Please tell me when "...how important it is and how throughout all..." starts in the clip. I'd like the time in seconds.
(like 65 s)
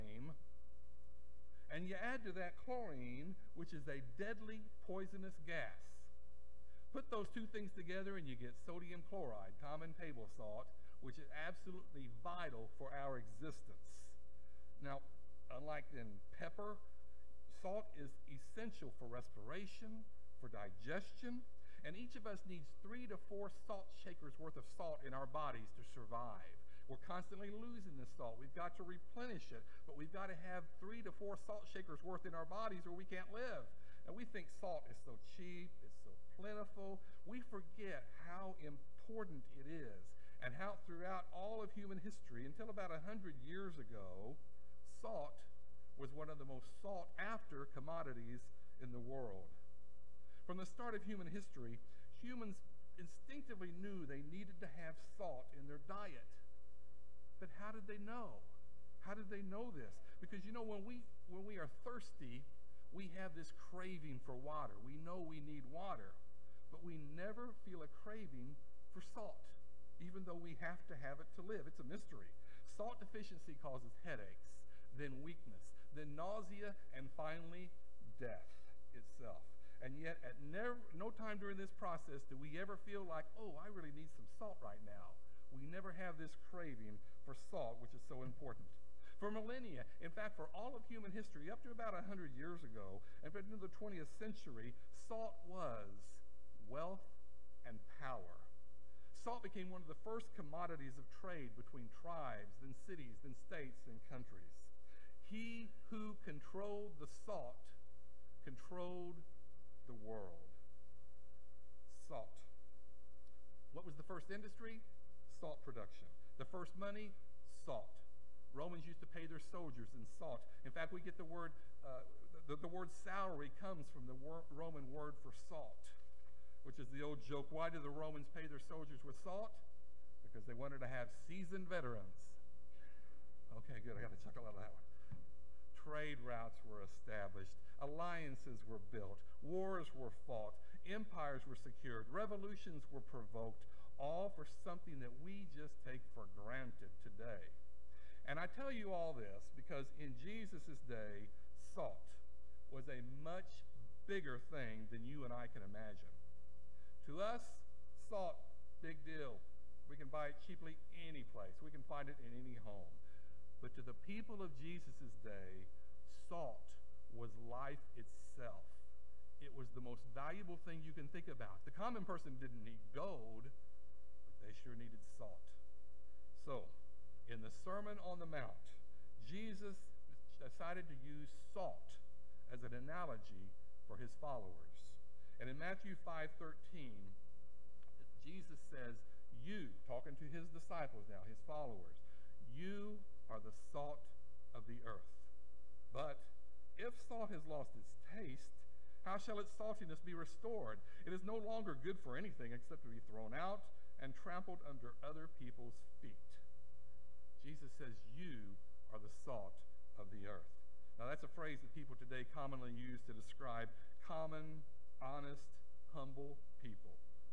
38 s.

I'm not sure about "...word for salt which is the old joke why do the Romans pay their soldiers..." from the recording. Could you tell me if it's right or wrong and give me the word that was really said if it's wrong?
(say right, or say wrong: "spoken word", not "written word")
right.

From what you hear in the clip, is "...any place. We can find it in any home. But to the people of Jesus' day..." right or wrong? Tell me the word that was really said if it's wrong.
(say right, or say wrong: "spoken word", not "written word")
right.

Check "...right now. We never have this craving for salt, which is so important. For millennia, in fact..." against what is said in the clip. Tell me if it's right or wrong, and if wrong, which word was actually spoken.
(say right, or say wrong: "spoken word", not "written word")
right.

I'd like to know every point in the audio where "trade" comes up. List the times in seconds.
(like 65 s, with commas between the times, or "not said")
101 s, 135 s.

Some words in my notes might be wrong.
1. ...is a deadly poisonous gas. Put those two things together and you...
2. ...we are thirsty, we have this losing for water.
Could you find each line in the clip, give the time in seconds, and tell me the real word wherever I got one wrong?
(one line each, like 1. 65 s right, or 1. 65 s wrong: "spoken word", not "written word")
1. 3 s right
2. 61 s wrong: "craving", not "losing".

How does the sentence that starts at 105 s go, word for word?
He who controlled the salt controlled the world.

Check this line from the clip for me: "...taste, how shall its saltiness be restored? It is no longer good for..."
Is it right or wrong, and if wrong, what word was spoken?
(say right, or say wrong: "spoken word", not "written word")
right.